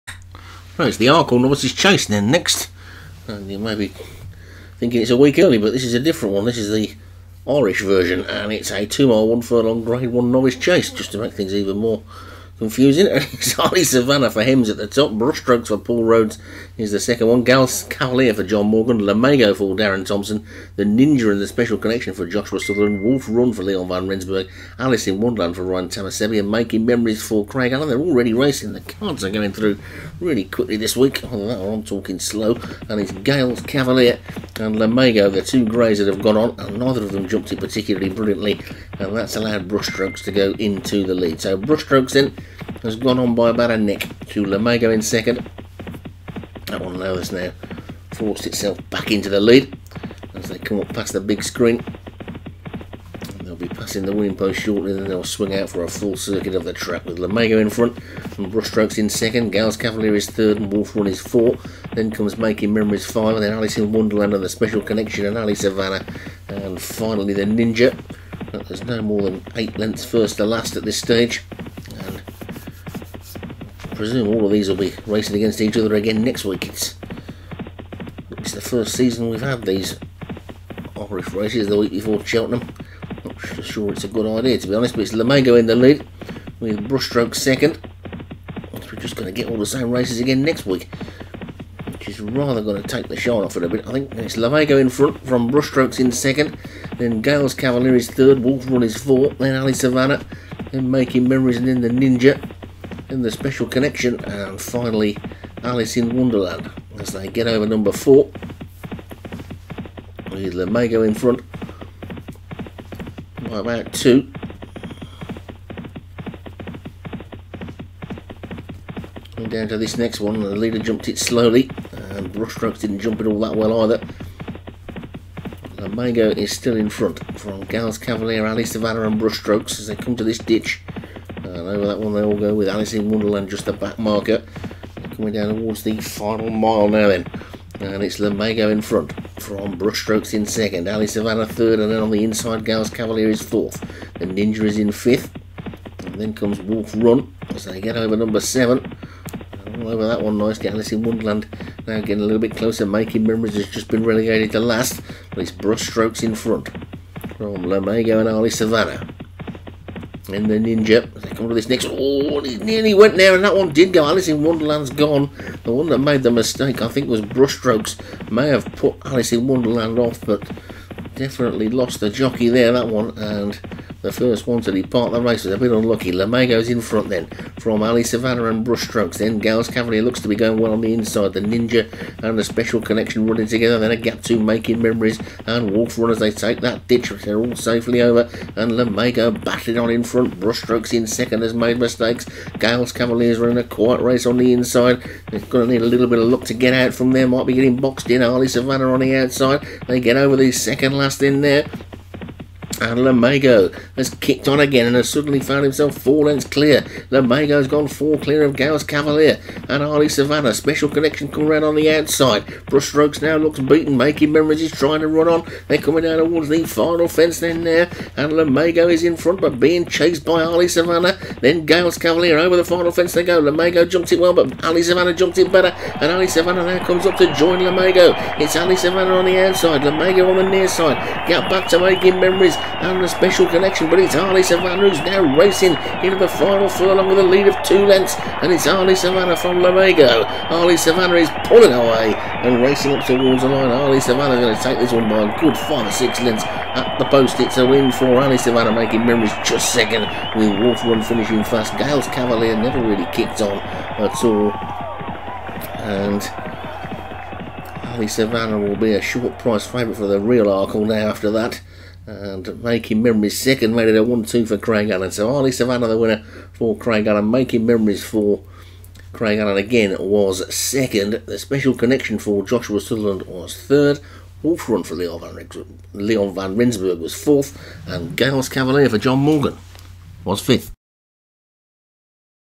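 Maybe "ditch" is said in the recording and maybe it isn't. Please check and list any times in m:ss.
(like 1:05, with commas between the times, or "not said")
2:10, 3:06.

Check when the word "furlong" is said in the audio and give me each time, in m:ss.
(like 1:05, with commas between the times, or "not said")
0:09, 3:56.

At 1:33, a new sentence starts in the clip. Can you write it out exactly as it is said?
I think it's Lamego in front from Brushstrokes in second.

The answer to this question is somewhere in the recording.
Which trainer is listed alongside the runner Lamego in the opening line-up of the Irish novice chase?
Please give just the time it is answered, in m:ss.
0:19.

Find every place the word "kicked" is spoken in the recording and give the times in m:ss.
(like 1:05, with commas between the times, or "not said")
3:24, 4:13.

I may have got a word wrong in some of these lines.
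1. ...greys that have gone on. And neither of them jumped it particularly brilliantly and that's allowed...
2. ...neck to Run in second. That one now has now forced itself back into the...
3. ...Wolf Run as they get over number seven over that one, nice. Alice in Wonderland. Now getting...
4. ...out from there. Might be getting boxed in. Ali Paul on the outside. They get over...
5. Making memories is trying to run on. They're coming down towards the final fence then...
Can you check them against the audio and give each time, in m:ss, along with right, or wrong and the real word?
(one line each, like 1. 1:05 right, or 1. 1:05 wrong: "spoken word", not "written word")
1. 0:35 right
2. 0:43 wrong: "Lamego", not "Run"
3. 2:26 right
4. 3:16 wrong: "Savannah", not "Paul"
5. 3:33 right.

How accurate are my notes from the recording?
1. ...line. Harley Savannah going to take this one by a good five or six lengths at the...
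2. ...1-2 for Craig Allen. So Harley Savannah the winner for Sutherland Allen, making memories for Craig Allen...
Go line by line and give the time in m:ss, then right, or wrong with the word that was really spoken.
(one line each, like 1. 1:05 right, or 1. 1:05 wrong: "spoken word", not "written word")
1. 4:03 right
2. 4:24 wrong: "Craig", not "Sutherland".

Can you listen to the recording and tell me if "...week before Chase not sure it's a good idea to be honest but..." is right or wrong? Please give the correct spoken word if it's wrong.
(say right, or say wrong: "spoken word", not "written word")
wrong: "Cheltenham", not "Chase".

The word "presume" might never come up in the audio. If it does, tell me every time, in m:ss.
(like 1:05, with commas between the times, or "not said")
1:13.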